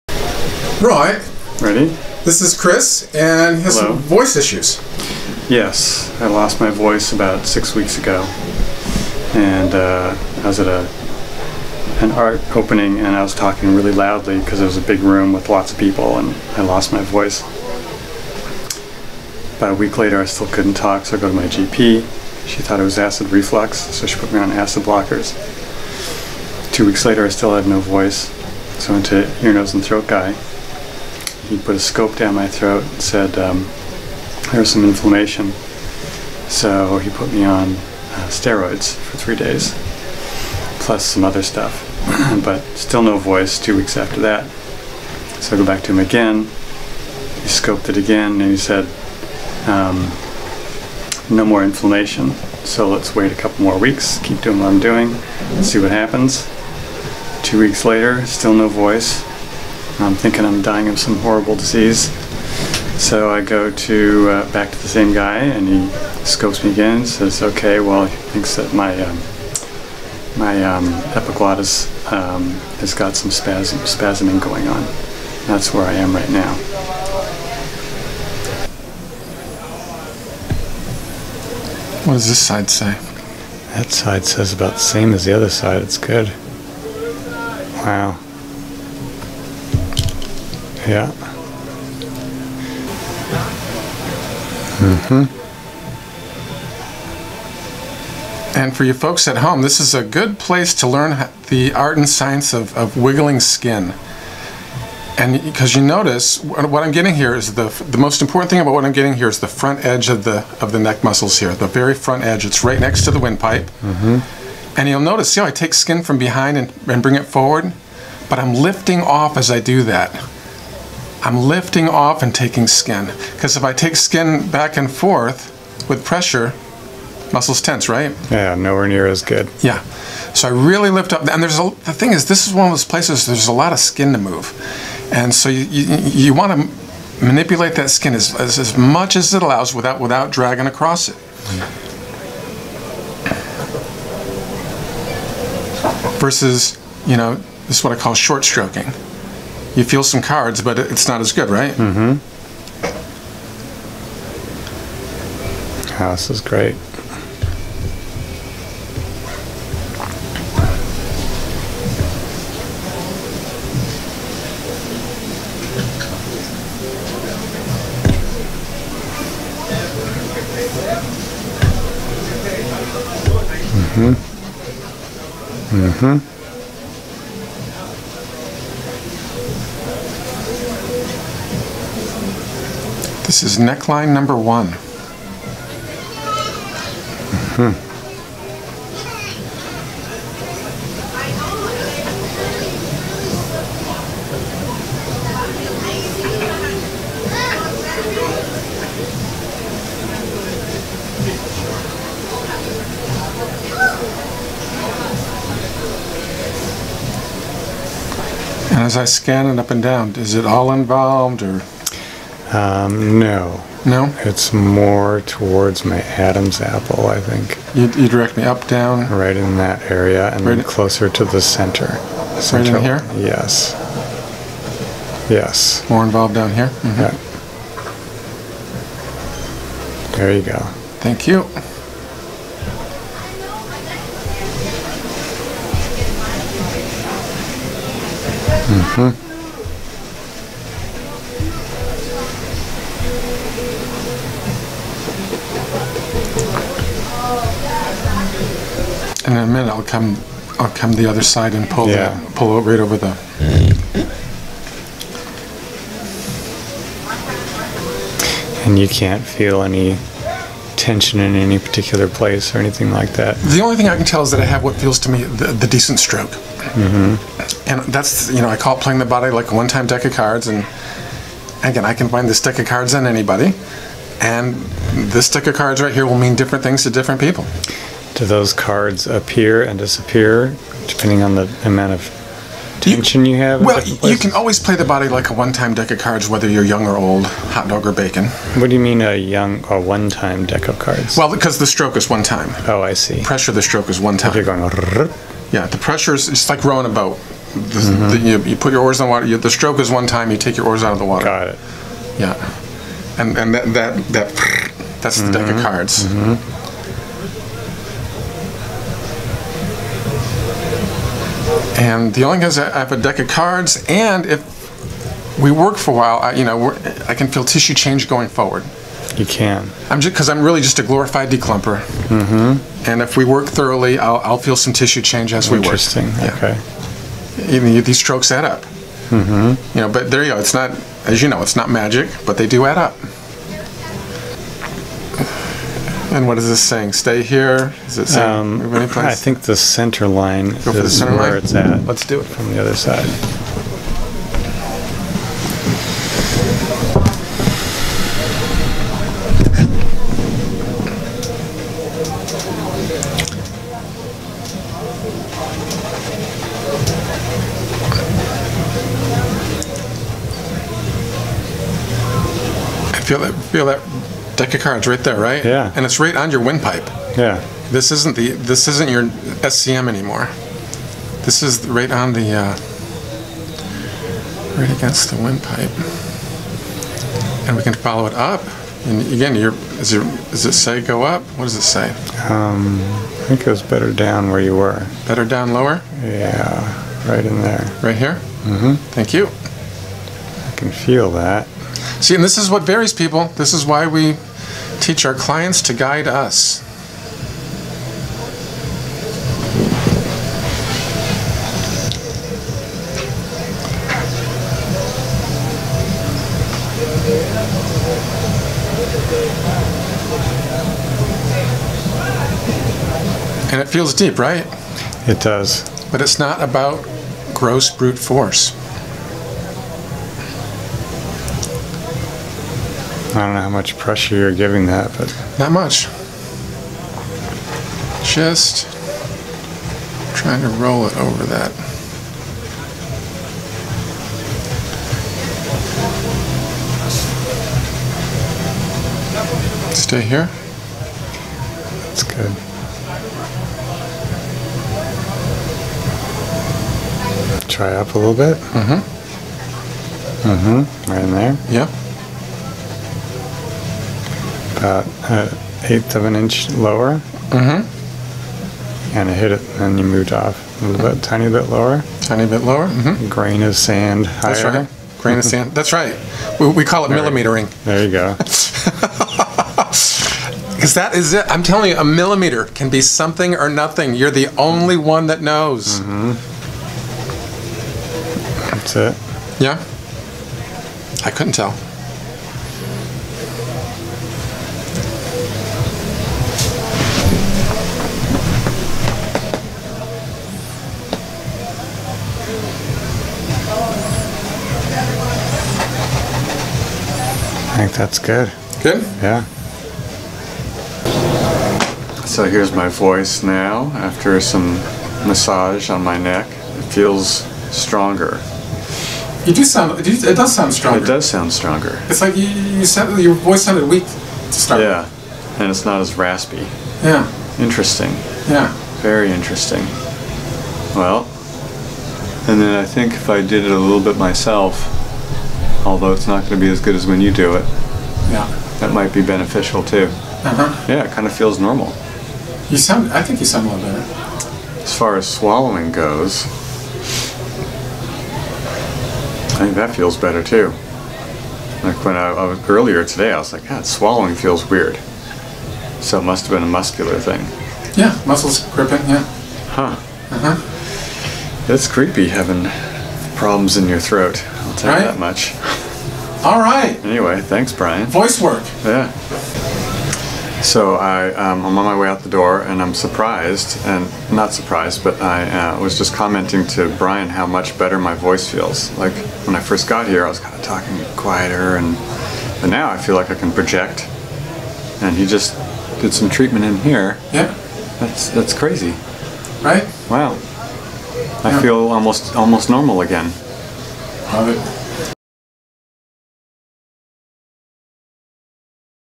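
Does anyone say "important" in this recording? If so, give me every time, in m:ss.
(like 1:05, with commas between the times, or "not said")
1:48.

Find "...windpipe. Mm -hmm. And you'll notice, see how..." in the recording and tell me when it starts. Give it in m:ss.
1:53.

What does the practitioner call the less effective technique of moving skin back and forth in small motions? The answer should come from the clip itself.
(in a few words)
short stroking.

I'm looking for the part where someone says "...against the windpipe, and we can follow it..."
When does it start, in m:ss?
6:14.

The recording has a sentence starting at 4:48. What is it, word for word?
What do you mean a young or one-time deck of cards?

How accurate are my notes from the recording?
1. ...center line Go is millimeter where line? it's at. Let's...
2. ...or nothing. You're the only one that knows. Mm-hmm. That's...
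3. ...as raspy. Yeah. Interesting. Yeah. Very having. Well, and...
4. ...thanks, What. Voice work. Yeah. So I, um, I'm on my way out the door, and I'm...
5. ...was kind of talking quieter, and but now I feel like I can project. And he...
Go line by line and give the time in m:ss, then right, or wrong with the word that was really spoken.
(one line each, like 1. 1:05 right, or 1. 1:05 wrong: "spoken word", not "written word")
1. 5:39 wrong: "center", not "millimeter"
2. 7:53 right
3. 8:35 wrong: "interesting", not "having"
4. 9:17 wrong: "Brian", not "What"
5. 9:30 right.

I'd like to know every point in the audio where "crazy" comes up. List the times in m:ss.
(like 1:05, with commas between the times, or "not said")
9:38.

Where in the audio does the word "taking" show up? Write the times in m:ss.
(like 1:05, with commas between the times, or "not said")
2:02.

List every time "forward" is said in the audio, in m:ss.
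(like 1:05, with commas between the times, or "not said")
1:57, 5:18.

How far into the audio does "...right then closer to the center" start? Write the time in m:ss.
3:40.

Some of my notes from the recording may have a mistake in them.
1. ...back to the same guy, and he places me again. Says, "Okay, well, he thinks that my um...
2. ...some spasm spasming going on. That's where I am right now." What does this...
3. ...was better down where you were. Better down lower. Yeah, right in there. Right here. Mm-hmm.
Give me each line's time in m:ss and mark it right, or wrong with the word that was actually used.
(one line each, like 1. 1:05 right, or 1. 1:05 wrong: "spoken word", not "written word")
1. 1:04 wrong: "scopes", not "places"
2. 1:13 right
3. 6:23 right.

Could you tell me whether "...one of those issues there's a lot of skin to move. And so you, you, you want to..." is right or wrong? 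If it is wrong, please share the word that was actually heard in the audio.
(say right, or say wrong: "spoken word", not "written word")
wrong: "places", not "issues".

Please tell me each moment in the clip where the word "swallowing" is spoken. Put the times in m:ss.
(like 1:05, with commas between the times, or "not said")
8:55, 9:03.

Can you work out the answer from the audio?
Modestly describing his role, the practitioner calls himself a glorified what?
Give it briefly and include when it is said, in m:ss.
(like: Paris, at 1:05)
declumper, at 5:21.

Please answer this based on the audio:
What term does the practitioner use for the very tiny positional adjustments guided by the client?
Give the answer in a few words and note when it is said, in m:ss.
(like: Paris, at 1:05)
millimetering, at 7:46.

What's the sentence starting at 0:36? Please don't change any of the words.
So he put me on uh, steroids for three days, plus some other stuff.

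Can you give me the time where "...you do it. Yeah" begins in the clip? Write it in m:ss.
8:47.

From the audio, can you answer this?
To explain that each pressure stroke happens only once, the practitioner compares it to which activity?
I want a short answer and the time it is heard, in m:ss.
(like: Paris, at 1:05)
rowing a boat, at 4:56.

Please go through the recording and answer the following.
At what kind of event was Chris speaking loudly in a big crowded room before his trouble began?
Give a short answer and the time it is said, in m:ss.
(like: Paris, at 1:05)
an art opening, at 0:12.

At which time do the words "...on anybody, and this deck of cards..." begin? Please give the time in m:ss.
4:32.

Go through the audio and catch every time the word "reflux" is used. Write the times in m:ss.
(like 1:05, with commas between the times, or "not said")
0:23.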